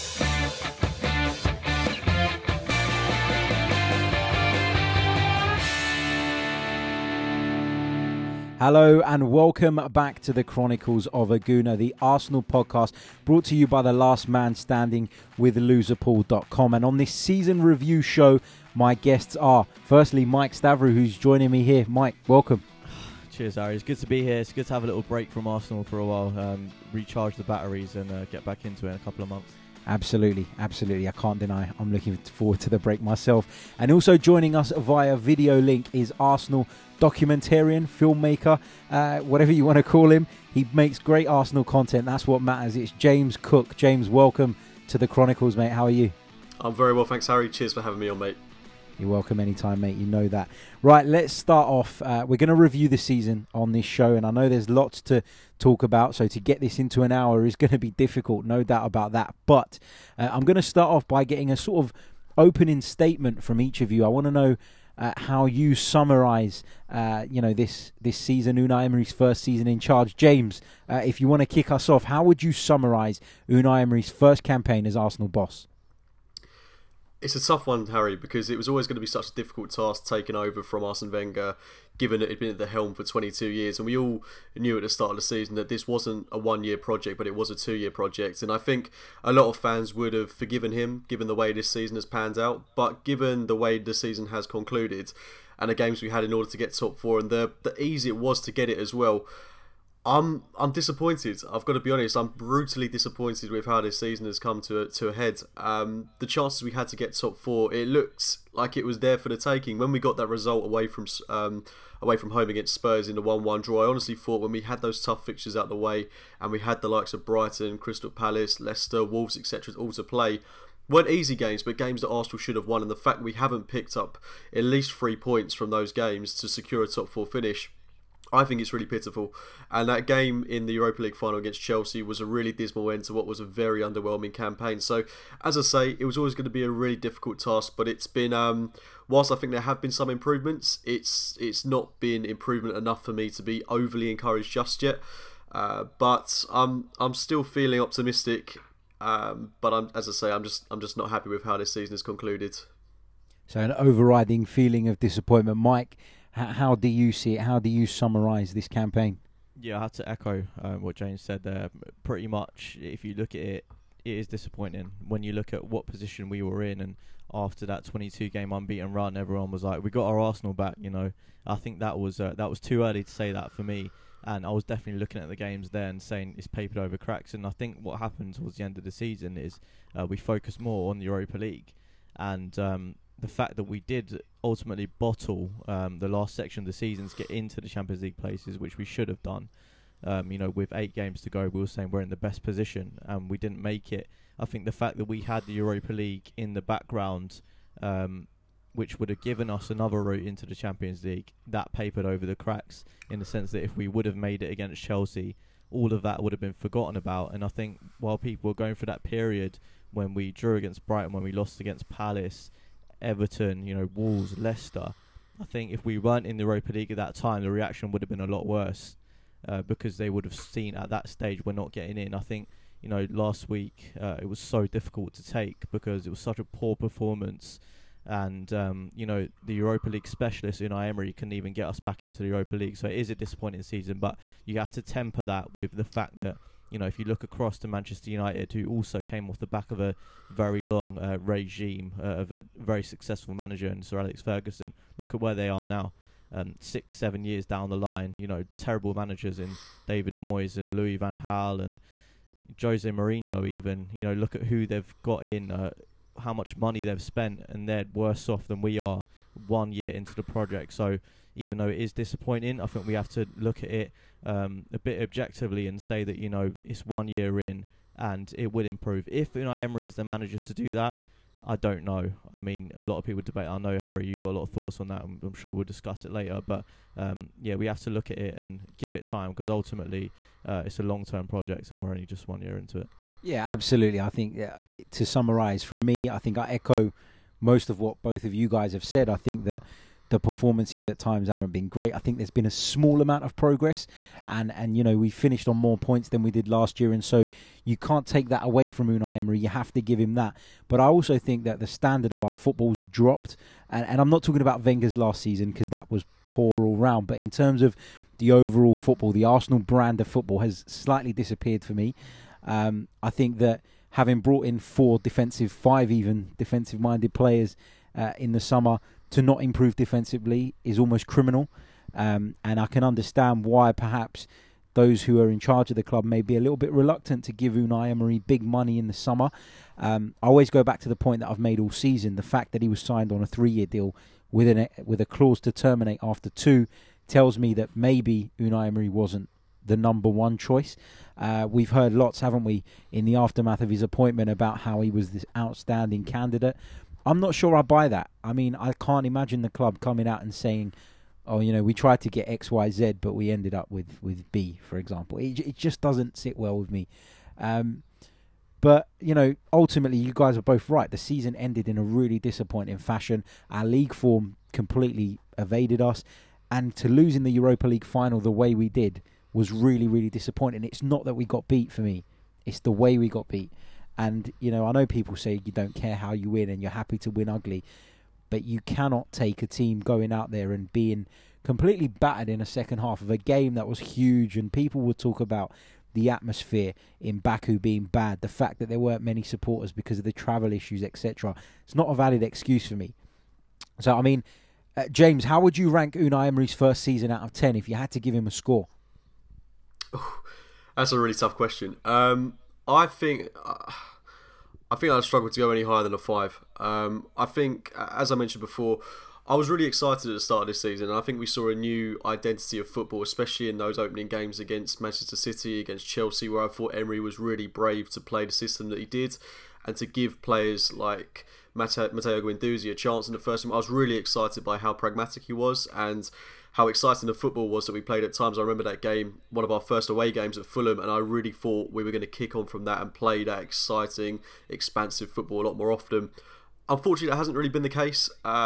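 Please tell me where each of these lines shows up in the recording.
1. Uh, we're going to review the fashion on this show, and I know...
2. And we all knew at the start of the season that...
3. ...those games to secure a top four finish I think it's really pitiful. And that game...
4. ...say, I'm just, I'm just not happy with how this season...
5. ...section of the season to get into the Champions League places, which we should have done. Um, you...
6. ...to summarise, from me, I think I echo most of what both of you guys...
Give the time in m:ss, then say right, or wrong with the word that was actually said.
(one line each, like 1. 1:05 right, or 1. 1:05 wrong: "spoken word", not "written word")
1. 0:52 wrong: "season", not "fashion"
2. 1:23 right
3. 2:05 right
4. 2:30 right
5. 3:06 right
6. 4:44 right.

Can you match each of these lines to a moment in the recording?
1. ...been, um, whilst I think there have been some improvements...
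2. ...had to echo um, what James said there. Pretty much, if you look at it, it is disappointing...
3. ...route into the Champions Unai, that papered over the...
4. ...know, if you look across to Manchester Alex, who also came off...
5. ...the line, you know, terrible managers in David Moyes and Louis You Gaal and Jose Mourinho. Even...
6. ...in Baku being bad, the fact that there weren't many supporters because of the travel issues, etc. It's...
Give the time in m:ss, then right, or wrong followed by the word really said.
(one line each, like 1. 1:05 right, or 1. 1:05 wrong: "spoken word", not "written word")
1. 2:18 right
2. 2:39 right
3. 3:20 wrong: "League", not "Unai"
4. 3:56 wrong: "United", not "Alex"
5. 4:07 wrong: "Van", not "You"
6. 6:26 right.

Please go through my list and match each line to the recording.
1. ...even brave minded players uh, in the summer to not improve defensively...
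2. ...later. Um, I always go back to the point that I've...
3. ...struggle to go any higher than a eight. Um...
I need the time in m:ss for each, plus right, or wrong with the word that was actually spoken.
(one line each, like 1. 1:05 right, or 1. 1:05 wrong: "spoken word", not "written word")
1. 5:15 wrong: "defensive", not "brave"
2. 5:28 wrong: "summer", not "later"
3. 6:45 wrong: "five", not "eight".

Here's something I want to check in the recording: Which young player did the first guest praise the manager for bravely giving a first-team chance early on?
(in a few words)
Mateo Guendouzi.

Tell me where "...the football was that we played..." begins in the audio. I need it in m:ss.
7:07.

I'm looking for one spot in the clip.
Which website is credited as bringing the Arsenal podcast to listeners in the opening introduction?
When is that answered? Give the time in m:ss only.
0:15.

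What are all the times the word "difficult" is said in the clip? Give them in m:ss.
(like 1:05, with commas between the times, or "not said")
0:57, 1:19, 2:16, 3:44.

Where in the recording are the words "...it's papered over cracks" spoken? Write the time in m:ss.
2:56.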